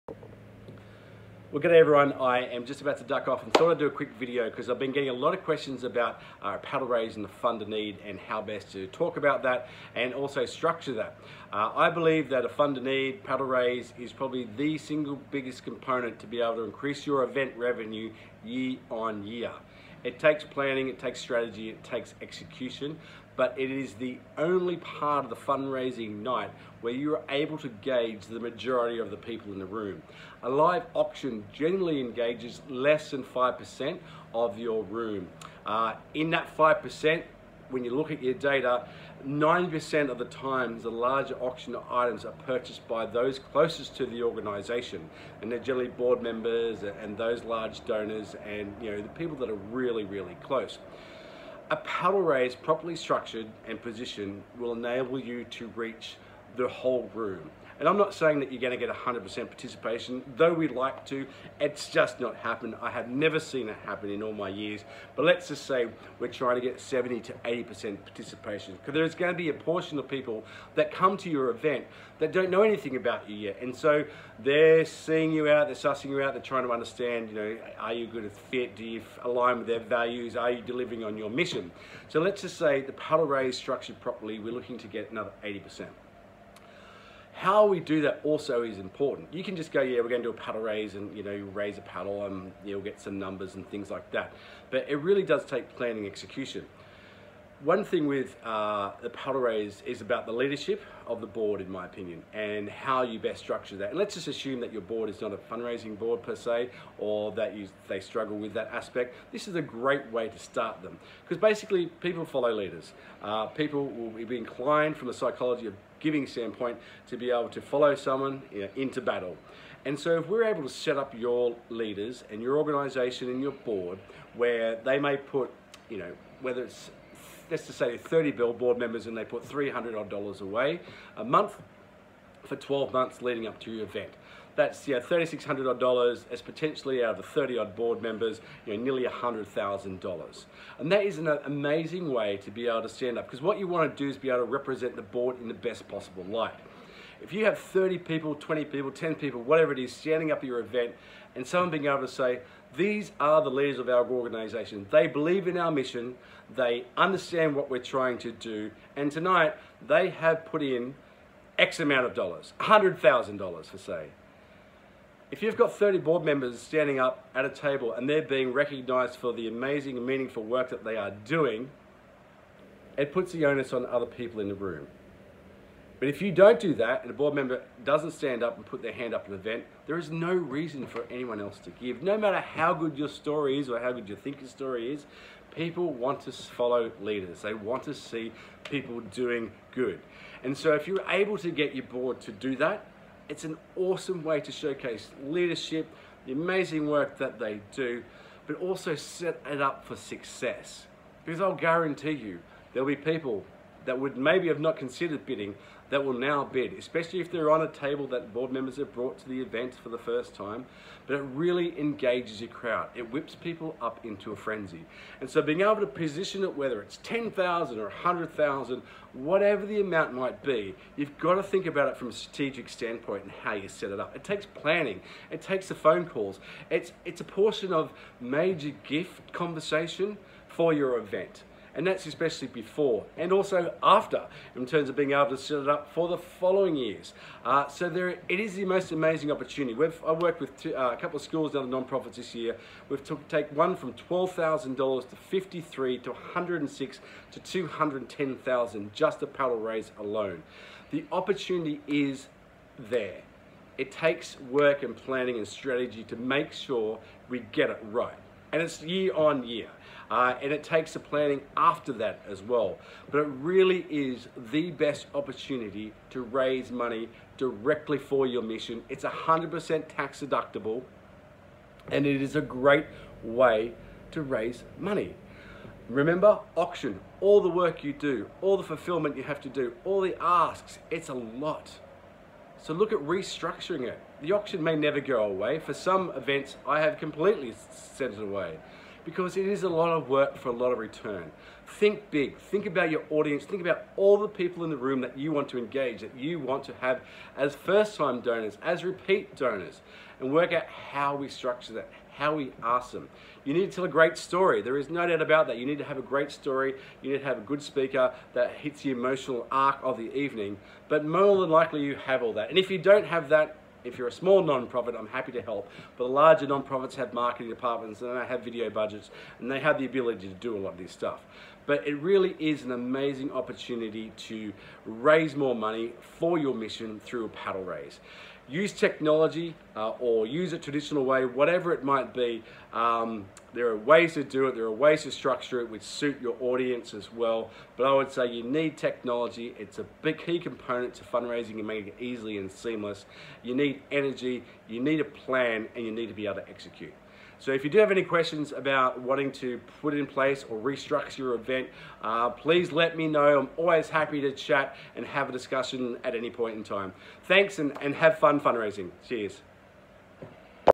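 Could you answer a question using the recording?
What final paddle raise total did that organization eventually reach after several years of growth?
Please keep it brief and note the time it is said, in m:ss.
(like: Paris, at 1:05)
$210,000, at 4:07.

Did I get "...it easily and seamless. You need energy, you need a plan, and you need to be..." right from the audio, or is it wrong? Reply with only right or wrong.
right.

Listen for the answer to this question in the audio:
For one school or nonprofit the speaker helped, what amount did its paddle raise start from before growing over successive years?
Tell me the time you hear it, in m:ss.
4:04.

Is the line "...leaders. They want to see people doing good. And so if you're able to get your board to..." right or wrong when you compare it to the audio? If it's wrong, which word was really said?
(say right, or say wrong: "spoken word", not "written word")
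right.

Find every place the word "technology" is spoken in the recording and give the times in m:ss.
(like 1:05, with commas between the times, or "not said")
5:28, 5:38.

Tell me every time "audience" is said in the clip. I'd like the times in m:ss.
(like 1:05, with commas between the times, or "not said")
4:53, 5:36.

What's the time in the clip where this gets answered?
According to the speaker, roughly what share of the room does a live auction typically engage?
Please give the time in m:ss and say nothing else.
0:32.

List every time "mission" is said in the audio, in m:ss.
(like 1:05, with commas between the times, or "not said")
1:21, 2:35, 4:28, 5:26.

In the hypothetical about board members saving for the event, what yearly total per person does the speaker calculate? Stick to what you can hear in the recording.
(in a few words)
$3,600.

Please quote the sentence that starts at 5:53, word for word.
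I'm always happy to chat and have a discussion at any point in time.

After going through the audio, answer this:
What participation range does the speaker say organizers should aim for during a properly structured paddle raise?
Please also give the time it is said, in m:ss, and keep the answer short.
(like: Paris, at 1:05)
70 to 80%, at 1:06.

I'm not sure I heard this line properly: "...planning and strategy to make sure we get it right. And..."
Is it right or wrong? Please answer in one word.
right.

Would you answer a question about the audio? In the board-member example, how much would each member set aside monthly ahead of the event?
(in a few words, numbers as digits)
$300.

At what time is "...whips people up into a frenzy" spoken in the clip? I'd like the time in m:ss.
3:33.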